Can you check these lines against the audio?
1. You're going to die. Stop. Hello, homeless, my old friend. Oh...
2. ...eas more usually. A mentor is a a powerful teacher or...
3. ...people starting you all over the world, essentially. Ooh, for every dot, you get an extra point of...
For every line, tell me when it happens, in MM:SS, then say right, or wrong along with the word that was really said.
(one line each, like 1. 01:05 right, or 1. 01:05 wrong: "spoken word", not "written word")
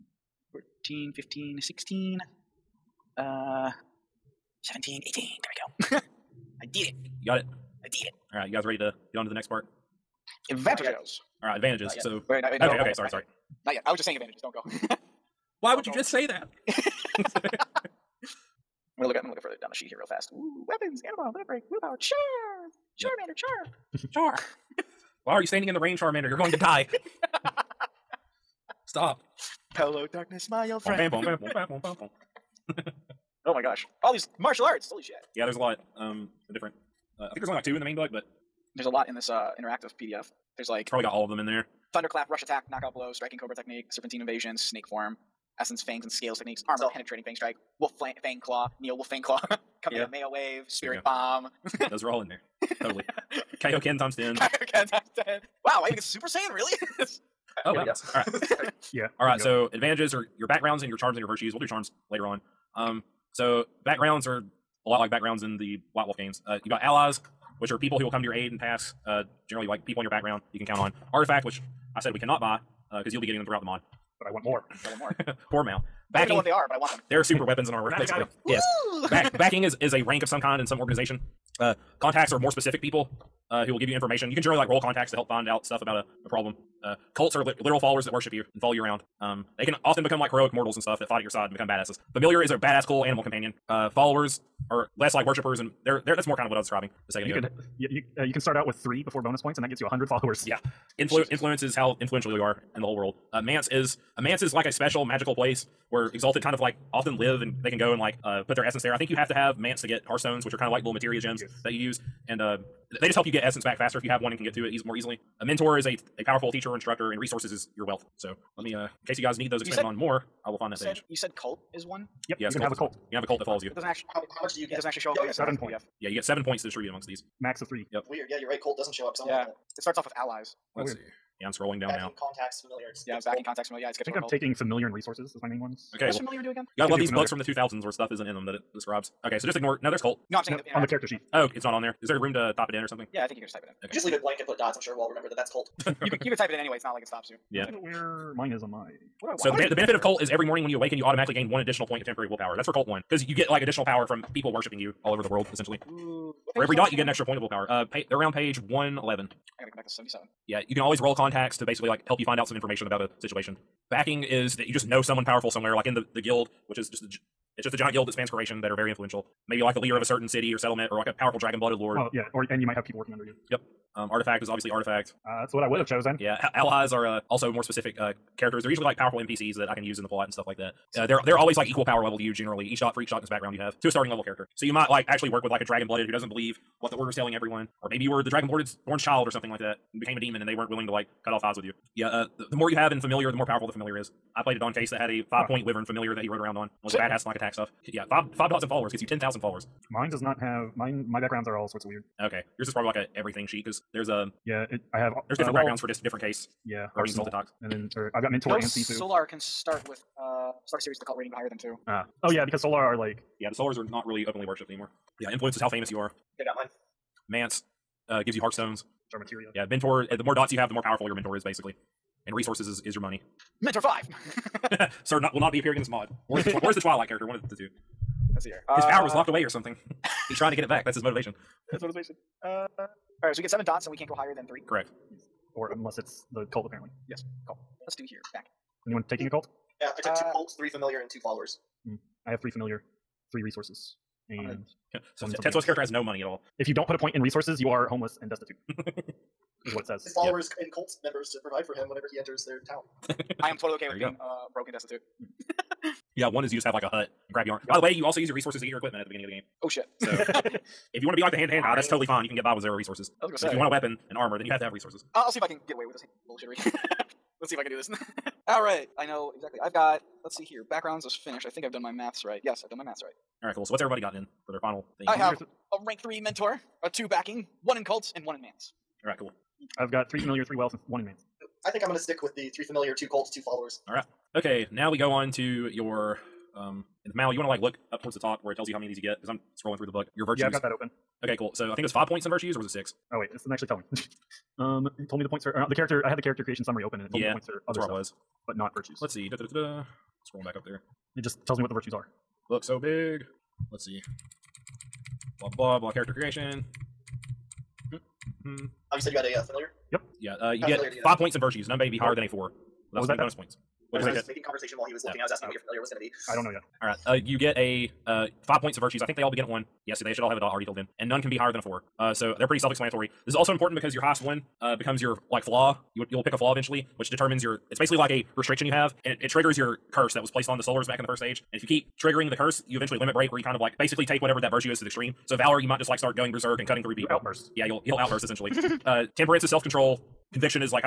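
1. 00:26 wrong: "darkness", not "homeless"
2. 01:54 wrong: "easily", not "usually"
3. 02:34 wrong: "worshiping", not "starting".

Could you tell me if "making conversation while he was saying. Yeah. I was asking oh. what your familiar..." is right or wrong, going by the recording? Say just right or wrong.
wrong.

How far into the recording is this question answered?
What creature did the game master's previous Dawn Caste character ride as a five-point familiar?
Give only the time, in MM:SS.
03:15.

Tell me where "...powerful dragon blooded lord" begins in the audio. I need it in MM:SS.
02:51.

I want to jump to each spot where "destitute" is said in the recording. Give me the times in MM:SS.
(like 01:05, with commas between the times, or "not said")
04:08, 04:14.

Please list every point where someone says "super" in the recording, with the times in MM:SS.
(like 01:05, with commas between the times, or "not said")
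00:56, 01:17.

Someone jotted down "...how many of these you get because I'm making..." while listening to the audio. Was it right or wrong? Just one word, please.
wrong.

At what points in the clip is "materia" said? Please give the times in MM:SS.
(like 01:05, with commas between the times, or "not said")
01:50, 03:39.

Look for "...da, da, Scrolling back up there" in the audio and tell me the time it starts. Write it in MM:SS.
04:59.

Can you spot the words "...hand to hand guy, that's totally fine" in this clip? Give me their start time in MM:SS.
04:21.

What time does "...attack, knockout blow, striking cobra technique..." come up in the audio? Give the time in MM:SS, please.
00:42.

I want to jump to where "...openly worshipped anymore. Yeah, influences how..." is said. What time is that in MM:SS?
03:34.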